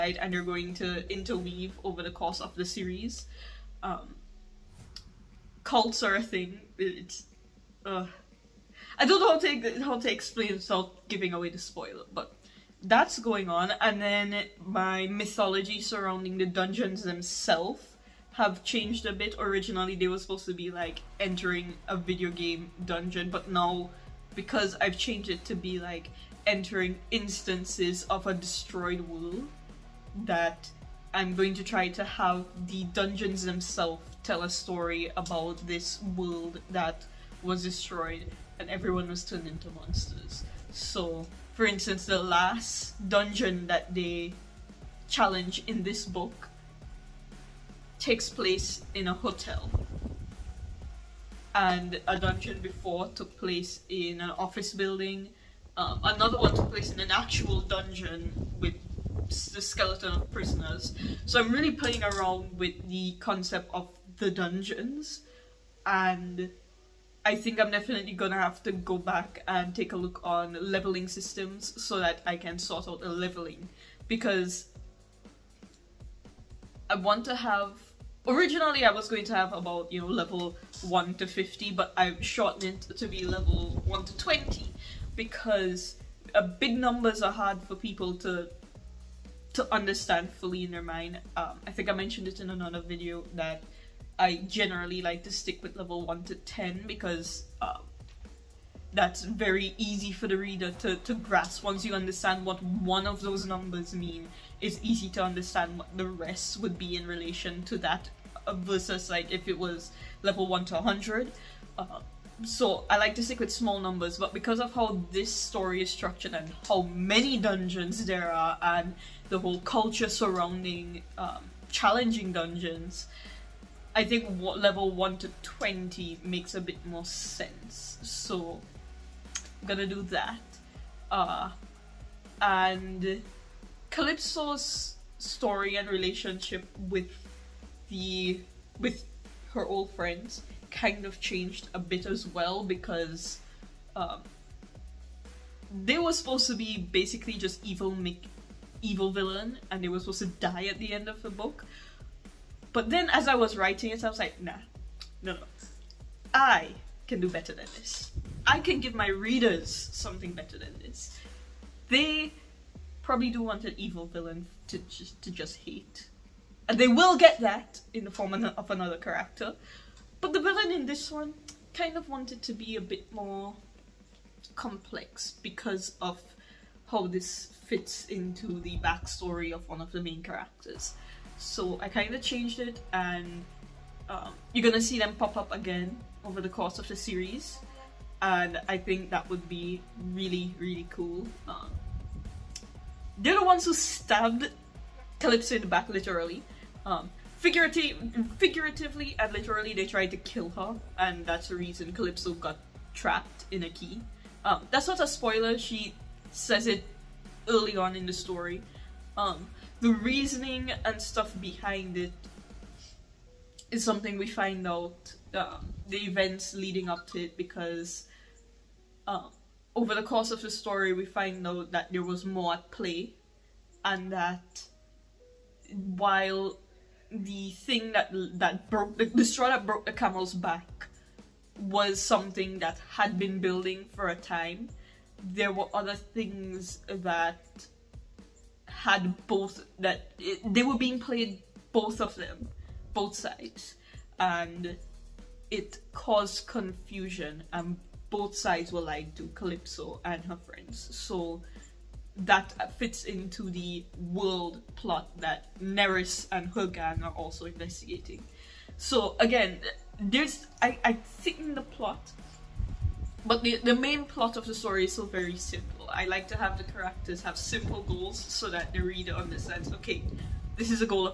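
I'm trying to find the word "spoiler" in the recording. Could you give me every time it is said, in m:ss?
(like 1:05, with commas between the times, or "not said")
0:11, 3:25.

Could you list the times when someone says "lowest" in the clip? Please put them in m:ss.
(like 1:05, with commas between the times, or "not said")
not said.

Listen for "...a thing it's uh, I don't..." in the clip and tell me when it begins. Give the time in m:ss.
0:06.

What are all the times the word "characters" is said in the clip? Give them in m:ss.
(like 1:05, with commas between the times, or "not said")
2:48, 3:00, 4:26.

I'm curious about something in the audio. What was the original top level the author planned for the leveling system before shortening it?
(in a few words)
50.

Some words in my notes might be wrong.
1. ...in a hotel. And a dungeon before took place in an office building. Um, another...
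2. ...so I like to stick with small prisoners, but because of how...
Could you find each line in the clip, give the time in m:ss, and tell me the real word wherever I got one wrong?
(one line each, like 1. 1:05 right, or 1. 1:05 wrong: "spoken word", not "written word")
1. 0:48 right
2. 1:52 wrong: "numbers", not "prisoners".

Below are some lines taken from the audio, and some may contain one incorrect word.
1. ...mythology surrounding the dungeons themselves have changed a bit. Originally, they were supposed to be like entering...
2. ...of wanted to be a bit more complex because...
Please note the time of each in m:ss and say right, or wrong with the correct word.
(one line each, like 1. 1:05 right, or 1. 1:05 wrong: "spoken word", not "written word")
1. 0:15 right
2. 2:51 right.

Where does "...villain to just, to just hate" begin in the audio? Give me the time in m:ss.
2:44.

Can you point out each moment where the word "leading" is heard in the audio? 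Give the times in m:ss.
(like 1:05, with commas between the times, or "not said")
3:36.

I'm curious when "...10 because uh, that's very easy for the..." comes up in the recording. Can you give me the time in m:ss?
1:36.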